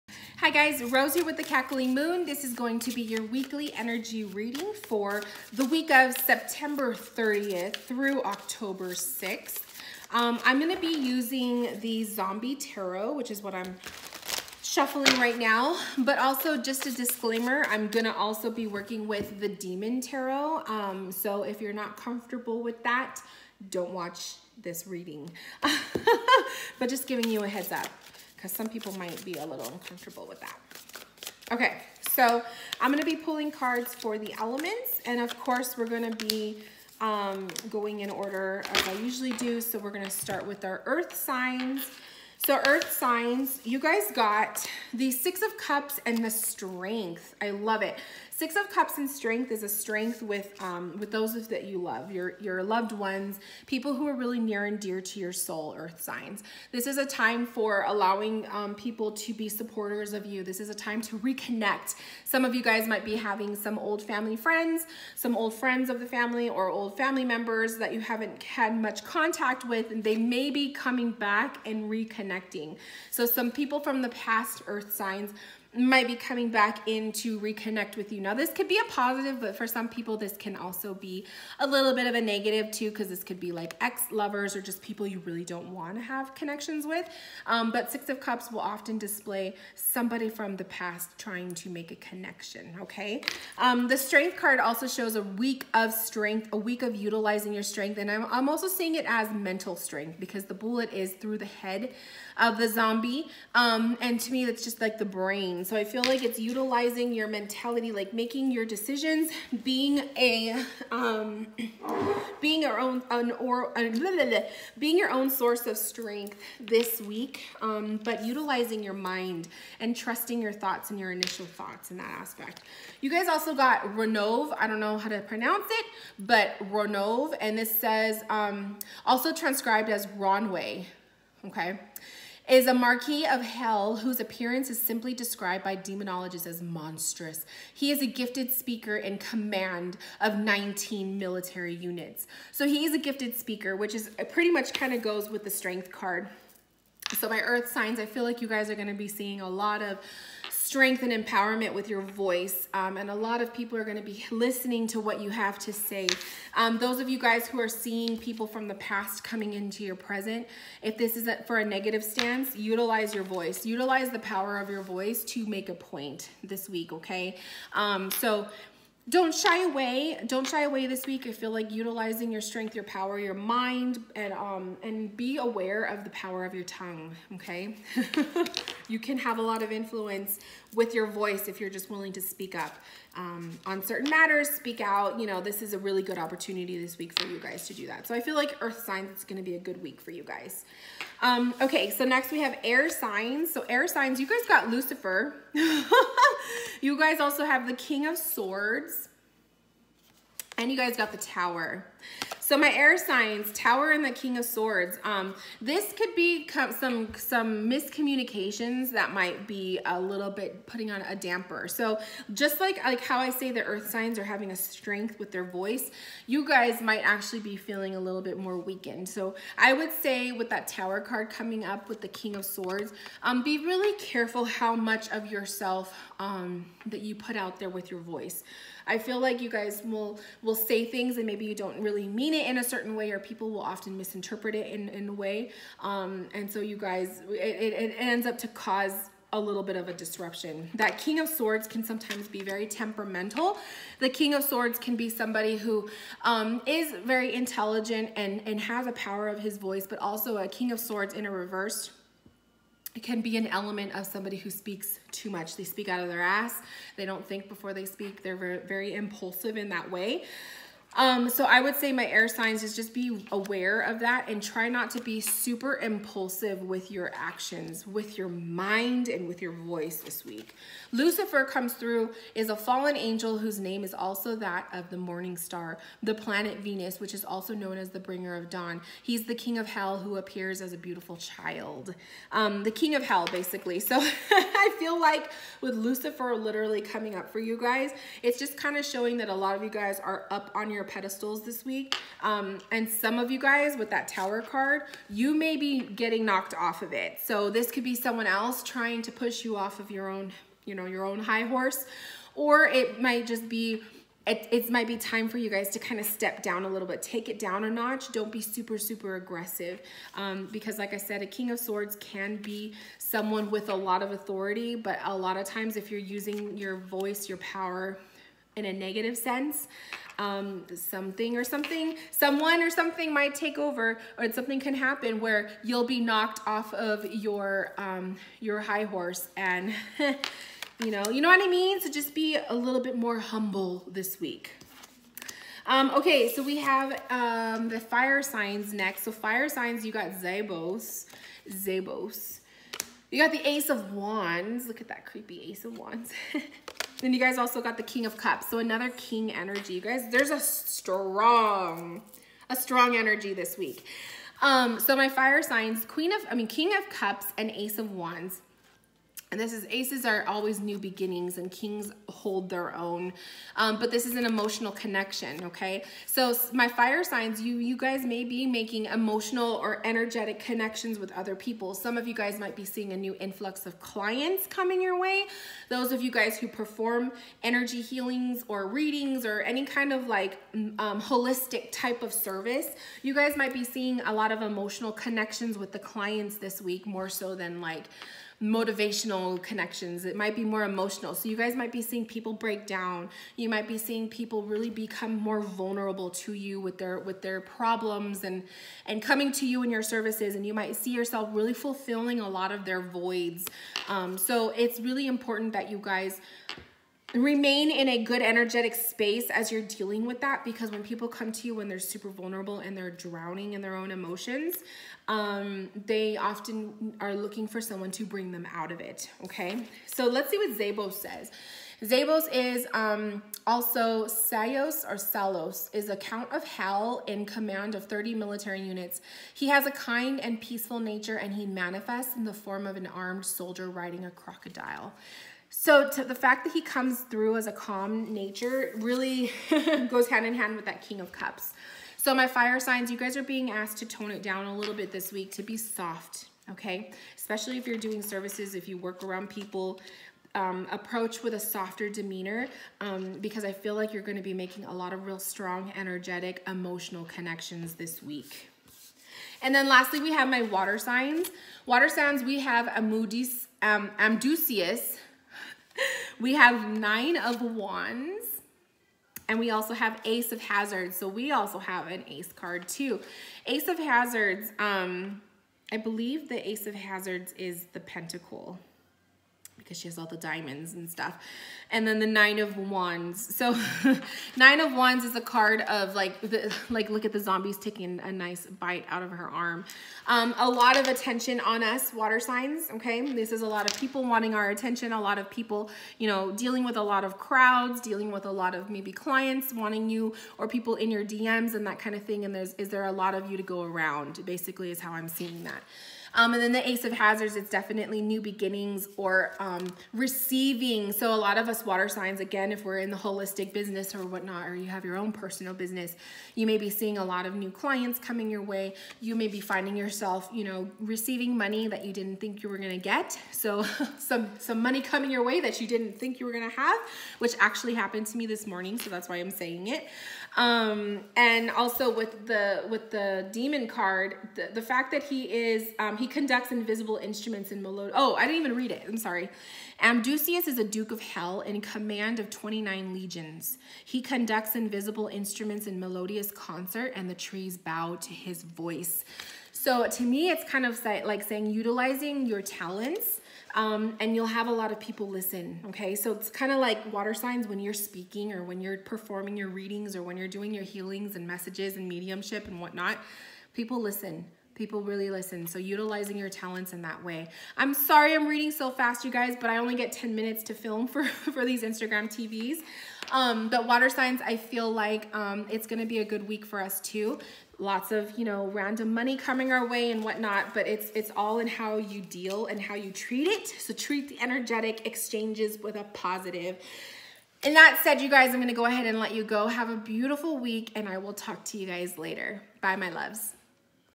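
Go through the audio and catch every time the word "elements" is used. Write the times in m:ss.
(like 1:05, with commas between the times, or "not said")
0:34, 4:13.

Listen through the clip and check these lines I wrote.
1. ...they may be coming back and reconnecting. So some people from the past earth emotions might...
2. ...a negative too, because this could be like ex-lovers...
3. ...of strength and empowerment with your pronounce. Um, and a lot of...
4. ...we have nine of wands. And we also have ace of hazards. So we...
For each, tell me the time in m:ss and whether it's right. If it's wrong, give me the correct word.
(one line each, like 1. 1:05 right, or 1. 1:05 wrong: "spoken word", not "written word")
1. 1:10 wrong: "signs", not "emotions"
2. 1:22 right
3. 2:29 wrong: "voice", not "pronounce"
4. 7:46 right.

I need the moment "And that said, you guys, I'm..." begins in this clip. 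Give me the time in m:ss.
9:47.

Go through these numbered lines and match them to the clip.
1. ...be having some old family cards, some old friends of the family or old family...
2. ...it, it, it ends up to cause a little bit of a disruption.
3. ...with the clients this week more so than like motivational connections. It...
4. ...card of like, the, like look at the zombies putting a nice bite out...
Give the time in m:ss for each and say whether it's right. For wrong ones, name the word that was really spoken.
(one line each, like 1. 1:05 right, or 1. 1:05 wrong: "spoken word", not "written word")
1. 1:03 wrong: "friends", not "cards"
2. 3:57 right
3. 6:25 right
4. 8:05 wrong: "taking", not "putting".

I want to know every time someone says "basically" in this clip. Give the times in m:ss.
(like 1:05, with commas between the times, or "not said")
4:43, 8:24.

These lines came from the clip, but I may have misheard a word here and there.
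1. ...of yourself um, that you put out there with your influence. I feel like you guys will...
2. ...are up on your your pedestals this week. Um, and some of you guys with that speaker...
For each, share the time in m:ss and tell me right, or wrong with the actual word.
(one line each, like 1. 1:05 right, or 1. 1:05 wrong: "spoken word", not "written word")
1. 3:45 wrong: "voice", not "influence"
2. 4:50 wrong: "tower", not "speaker".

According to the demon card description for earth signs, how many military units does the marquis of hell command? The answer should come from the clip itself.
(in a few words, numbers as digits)
19.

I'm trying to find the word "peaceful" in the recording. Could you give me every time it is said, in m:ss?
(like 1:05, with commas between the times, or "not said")
7:10.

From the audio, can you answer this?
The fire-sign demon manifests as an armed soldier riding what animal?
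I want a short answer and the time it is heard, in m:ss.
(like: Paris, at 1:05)
A crocodile, at 7:14.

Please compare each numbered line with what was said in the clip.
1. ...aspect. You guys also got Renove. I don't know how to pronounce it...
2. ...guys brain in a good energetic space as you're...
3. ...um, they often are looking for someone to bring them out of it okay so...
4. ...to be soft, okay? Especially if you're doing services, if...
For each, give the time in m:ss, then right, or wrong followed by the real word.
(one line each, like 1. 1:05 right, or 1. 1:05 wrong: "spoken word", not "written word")
1. 2:02 right
2. 6:45 wrong: "remain", not "brain"
3. 6:55 right
4. 7:25 right.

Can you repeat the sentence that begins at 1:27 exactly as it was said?
Um, but Six of Cups will often display somebody from the past trying to make a connection, okay?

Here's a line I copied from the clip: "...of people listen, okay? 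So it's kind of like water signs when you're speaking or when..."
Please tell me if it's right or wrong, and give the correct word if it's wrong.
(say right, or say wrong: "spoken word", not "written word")
right.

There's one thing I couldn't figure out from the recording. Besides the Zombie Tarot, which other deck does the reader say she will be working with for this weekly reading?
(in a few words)
Daemon Tarot.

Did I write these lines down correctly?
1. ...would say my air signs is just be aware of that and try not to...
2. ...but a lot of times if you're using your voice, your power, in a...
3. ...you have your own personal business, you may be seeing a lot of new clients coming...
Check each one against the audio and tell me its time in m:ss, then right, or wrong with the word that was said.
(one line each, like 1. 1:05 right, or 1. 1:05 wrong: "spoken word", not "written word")
1. 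4:21 right
2. 5:14 right
3. 8:34 right.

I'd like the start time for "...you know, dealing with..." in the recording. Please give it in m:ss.
8:15.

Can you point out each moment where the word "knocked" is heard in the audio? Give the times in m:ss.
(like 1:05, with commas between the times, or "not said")
4:56, 5:25.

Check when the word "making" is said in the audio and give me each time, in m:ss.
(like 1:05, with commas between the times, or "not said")
1:48, 6:08, 7:34.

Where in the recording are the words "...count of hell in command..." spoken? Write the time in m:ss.
7:05.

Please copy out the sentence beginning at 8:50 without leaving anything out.
Um, and also with the, with the demon card, the, the fact that he is, um, he conducts invisible instruments in Melod.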